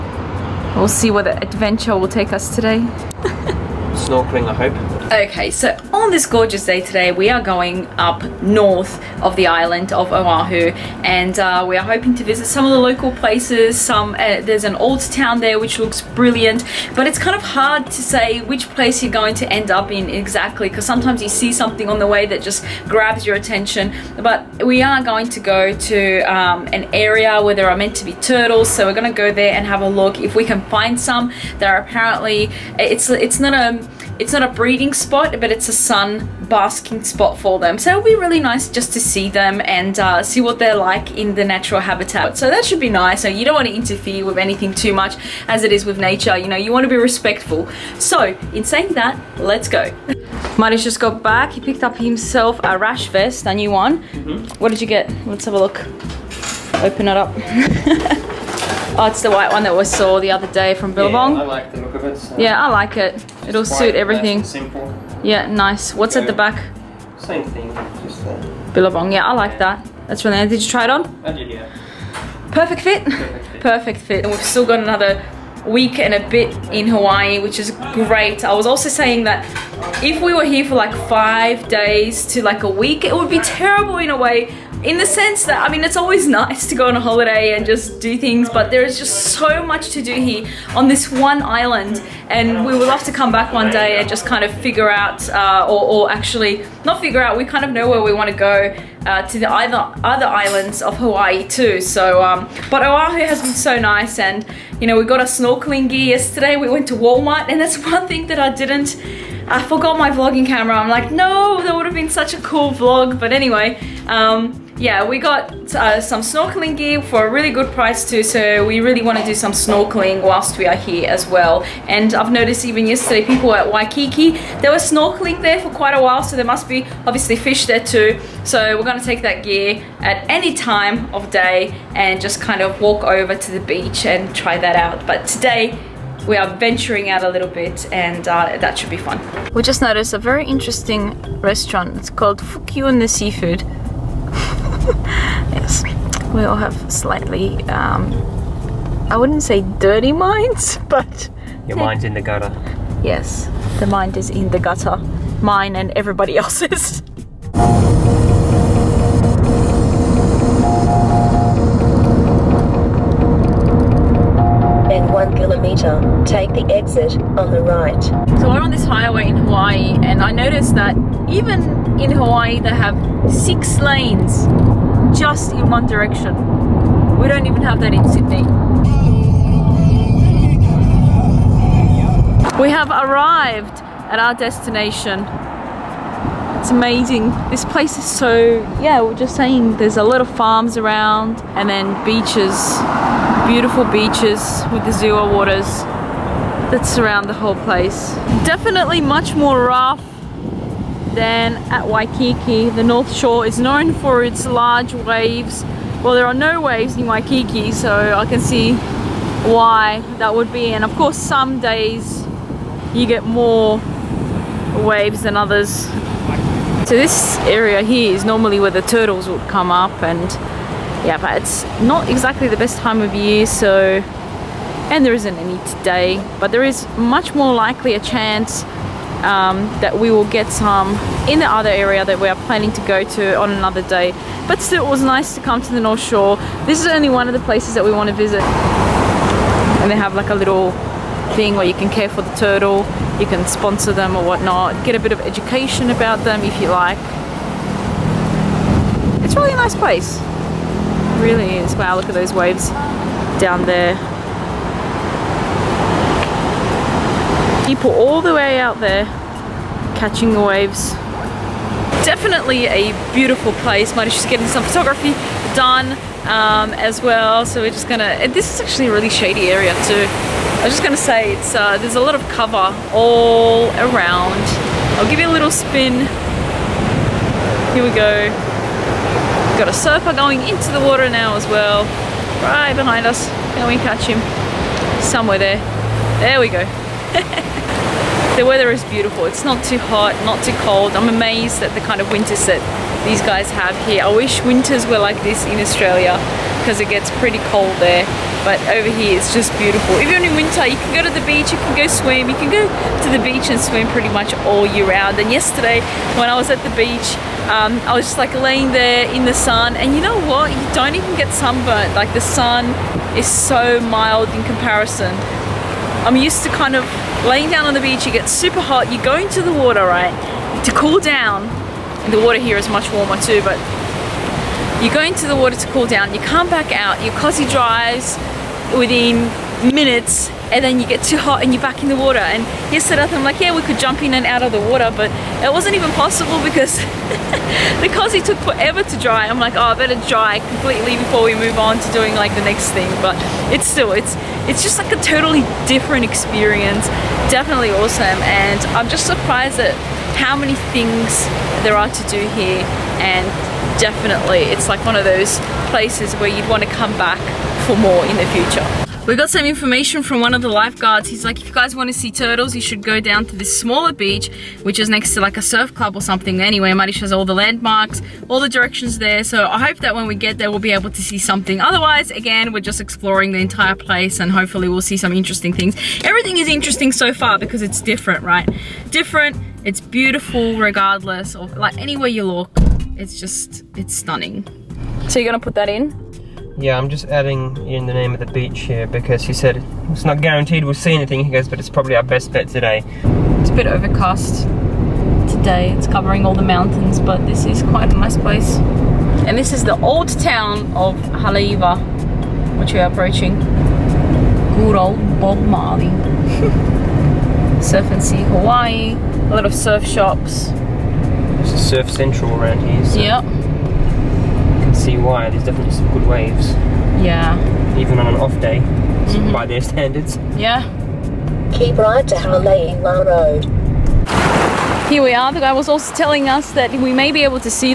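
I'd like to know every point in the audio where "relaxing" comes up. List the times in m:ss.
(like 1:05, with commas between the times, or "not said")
not said.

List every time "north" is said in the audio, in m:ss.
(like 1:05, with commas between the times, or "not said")
0:08, 3:22, 3:55.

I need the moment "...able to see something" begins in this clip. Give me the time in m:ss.
6:10.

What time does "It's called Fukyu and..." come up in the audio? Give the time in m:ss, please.
2:21.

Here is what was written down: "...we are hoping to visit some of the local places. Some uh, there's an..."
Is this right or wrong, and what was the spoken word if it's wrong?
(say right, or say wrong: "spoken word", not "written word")
right.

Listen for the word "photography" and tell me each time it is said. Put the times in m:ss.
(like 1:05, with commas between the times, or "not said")
4:24.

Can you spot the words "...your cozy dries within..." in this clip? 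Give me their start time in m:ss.
5:27.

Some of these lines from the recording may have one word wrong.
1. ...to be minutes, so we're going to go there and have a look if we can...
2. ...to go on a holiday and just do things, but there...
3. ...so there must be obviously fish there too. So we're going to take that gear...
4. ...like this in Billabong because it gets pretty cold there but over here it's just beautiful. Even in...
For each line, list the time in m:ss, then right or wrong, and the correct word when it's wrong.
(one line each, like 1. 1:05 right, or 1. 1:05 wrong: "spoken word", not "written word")
1. 0:27 wrong: "turtles", not "minutes"
2. 1:26 right
3. 2:06 right
4. 4:54 wrong: "Australia", not "Billabong".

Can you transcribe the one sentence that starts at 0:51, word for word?
He picked up himself a rash vest, a new one.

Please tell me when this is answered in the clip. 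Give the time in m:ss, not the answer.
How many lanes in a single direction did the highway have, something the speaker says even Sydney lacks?
2:53.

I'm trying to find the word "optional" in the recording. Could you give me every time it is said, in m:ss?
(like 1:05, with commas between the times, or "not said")
not said.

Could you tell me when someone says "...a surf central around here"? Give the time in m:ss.
6:51.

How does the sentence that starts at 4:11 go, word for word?
Wow, look at those waves down there.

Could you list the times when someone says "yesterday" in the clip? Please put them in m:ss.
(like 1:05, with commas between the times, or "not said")
1:46, 2:02, 5:05, 5:32.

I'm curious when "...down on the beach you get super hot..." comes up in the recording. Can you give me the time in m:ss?
5:17.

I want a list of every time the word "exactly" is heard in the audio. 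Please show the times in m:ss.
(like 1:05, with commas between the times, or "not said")
0:20, 3:42.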